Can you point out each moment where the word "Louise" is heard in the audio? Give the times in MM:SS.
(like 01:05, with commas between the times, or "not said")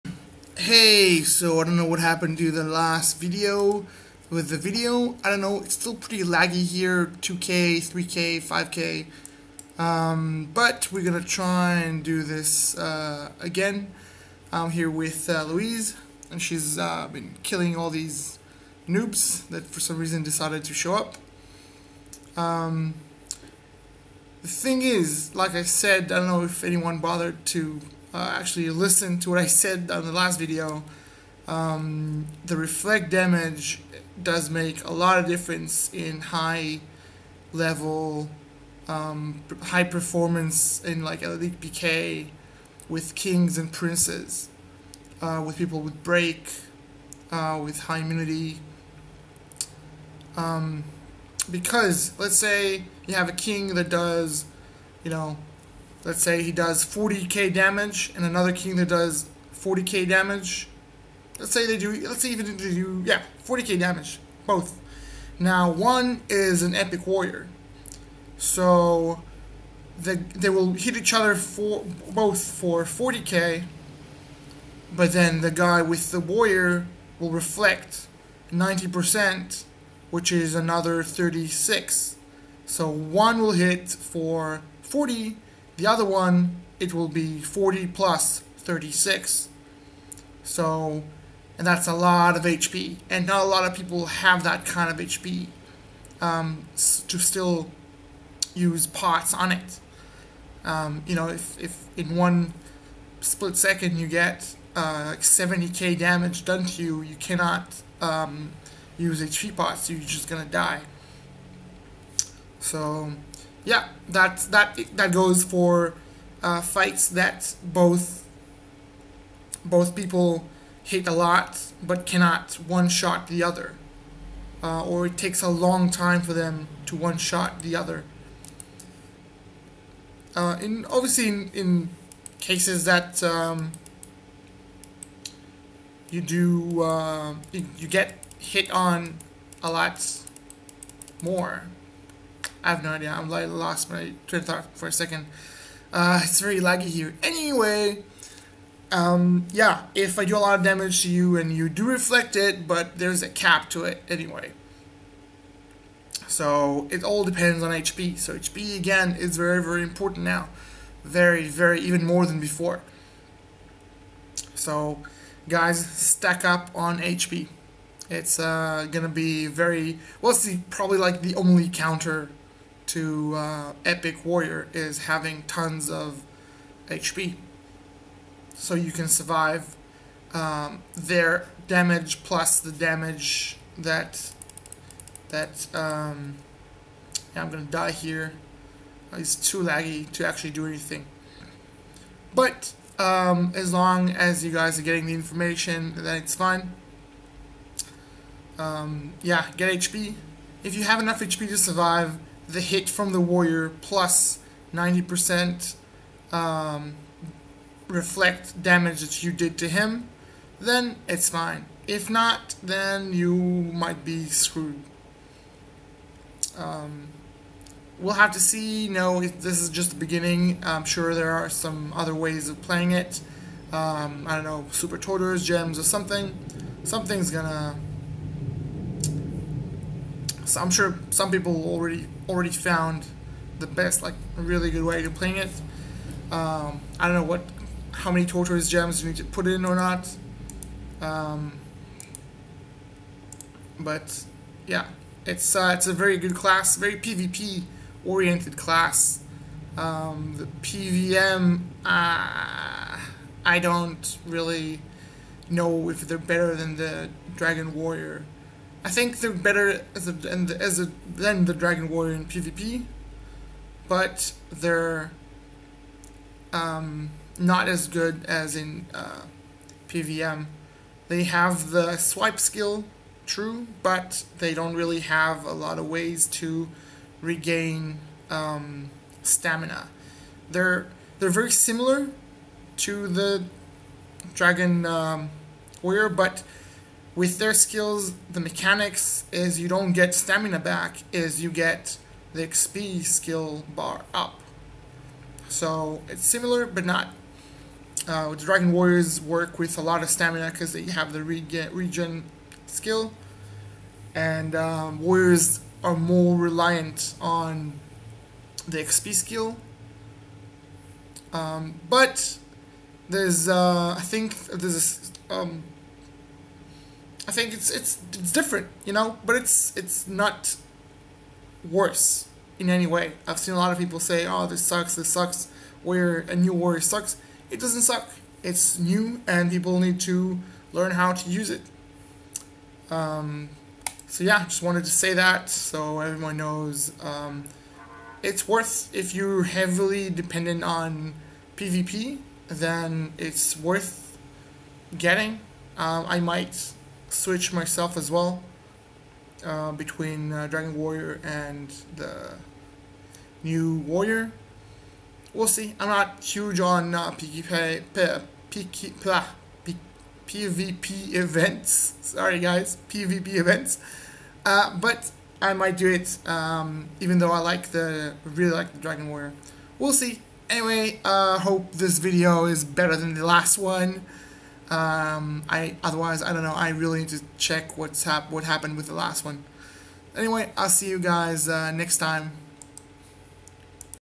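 00:15.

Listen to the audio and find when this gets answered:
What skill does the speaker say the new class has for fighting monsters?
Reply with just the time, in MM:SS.
04:31.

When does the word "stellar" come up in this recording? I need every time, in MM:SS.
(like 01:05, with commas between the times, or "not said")
not said.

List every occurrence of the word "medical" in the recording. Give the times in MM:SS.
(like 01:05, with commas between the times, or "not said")
not said.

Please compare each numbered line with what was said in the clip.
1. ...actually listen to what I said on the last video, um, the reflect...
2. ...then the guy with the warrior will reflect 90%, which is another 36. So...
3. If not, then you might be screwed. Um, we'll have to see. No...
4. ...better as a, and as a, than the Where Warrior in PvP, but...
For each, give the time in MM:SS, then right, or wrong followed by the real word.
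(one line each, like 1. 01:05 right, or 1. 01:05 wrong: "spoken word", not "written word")
1. 00:28 right
2. 01:15 right
3. 03:31 right
4. 04:19 wrong: "Dragon", not "Where".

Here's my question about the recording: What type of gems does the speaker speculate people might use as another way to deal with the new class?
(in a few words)
super tortoise gems.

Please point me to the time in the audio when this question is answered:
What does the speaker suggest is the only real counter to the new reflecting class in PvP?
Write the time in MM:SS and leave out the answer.
02:55.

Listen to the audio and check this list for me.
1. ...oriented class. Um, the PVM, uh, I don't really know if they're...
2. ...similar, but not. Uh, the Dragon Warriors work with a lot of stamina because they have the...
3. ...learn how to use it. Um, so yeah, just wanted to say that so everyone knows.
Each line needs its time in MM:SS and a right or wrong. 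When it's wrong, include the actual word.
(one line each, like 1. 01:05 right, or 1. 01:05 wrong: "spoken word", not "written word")
1. 04:08 right
2. 04:56 right
3. 05:30 right.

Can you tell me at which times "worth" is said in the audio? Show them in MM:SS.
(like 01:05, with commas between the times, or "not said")
05:38, 05:43.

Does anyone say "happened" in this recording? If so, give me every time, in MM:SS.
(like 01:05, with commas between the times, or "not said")
00:01, 06:18.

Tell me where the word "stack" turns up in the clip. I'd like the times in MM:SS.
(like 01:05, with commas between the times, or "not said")
02:45.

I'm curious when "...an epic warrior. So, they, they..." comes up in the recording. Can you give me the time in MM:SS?
01:06.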